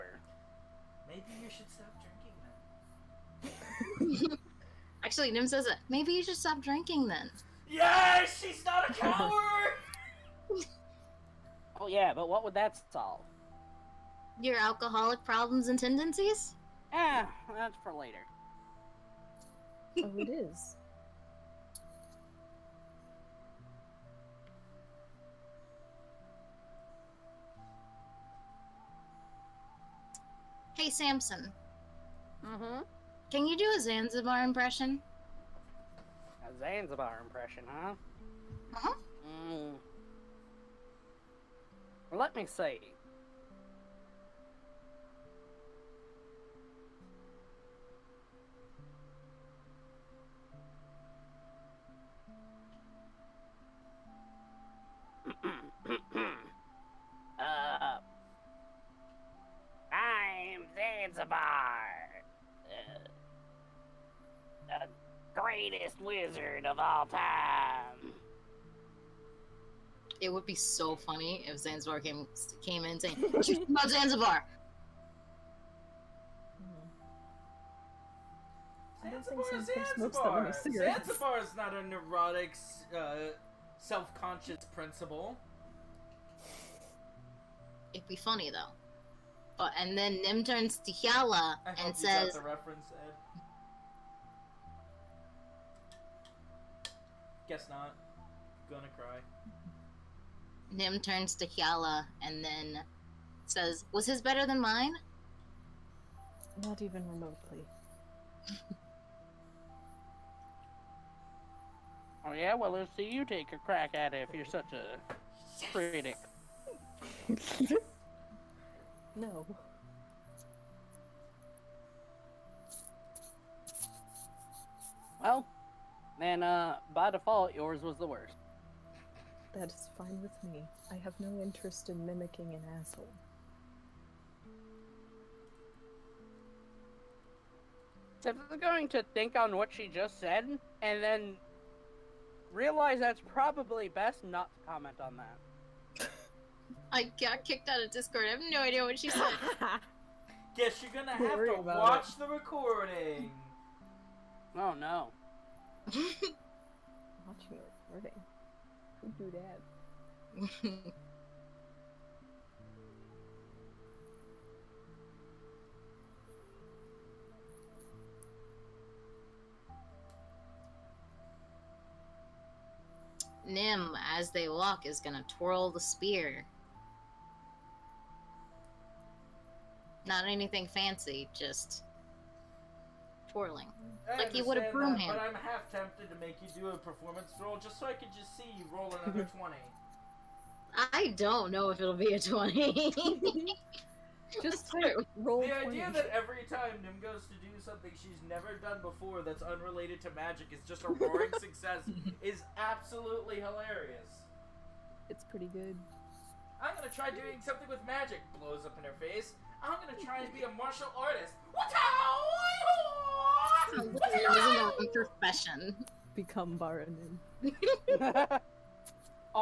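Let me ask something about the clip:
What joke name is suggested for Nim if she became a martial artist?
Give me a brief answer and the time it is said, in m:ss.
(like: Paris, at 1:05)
Baranim, at 3:36.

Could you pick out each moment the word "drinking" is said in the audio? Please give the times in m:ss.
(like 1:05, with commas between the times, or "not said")
0:02, 0:06.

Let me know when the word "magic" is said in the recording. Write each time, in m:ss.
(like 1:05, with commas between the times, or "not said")
3:20, 3:27.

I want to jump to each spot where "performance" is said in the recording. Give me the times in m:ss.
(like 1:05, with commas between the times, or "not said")
3:06.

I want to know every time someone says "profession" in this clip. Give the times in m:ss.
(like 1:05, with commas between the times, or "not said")
3:34.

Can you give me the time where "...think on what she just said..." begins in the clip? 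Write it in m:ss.
2:19.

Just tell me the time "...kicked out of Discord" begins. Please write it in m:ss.
2:27.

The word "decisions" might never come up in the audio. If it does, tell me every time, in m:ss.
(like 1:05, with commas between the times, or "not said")
not said.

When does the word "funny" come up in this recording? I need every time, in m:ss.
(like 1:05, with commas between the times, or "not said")
1:10, 1:28.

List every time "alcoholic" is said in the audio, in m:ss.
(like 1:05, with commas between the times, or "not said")
0:14.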